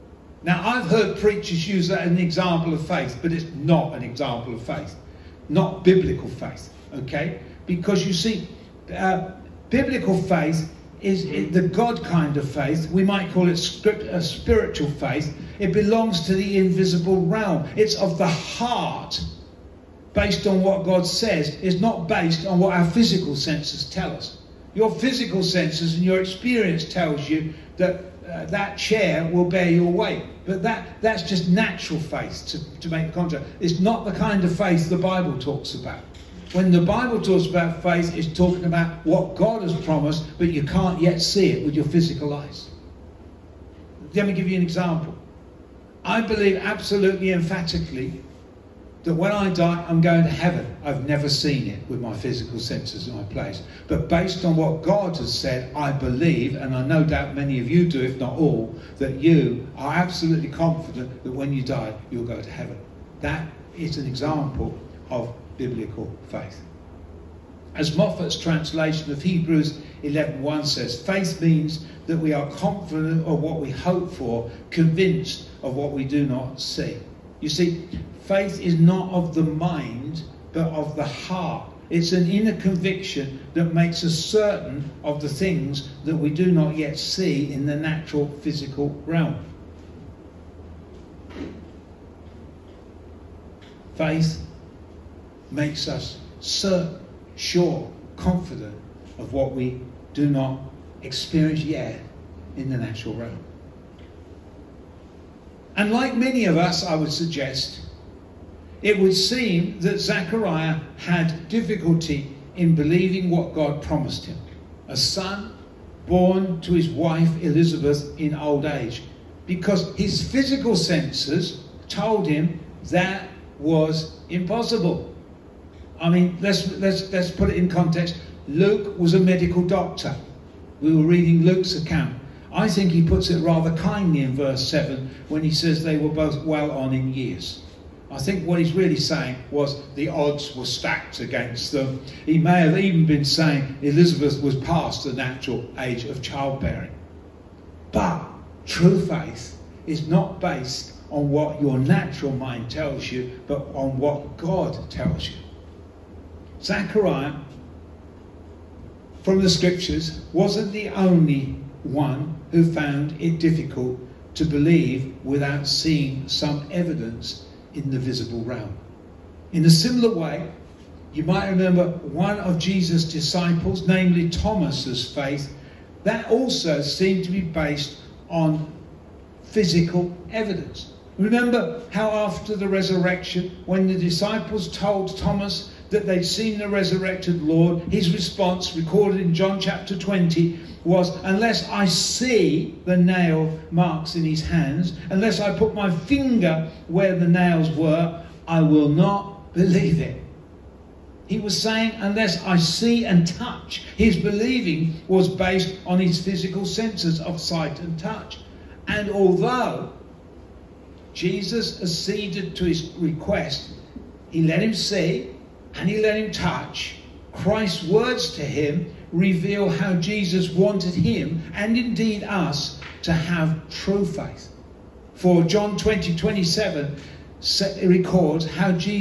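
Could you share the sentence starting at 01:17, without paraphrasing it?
You see, faith is not of the mind, but of the heart.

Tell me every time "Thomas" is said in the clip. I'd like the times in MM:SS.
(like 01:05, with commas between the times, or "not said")
02:54, 03:05.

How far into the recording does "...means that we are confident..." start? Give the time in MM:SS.
01:11.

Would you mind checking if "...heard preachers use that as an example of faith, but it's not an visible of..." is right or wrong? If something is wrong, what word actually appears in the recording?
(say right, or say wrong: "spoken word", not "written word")
wrong: "example", not "visible".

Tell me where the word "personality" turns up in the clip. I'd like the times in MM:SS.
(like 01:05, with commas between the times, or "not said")
not said.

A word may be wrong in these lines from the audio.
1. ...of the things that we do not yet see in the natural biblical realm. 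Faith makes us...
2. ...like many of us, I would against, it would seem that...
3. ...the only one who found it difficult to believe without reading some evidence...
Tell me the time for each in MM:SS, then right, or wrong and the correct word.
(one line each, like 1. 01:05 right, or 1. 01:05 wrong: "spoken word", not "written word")
1. 01:25 wrong: "physical", not "biblical"
2. 01:45 wrong: "suggest", not "against"
3. 02:40 wrong: "seeing", not "reading".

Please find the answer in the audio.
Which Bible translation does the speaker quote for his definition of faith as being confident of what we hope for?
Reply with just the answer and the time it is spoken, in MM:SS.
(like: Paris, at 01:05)
Moffatt's translation, at 01:07.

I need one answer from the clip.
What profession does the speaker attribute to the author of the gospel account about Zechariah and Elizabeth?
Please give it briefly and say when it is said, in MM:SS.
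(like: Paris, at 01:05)
Medical doctor, at 02:09.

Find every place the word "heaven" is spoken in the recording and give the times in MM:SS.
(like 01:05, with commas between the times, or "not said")
00:50, 01:02.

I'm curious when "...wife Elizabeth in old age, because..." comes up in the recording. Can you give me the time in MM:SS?
01:56.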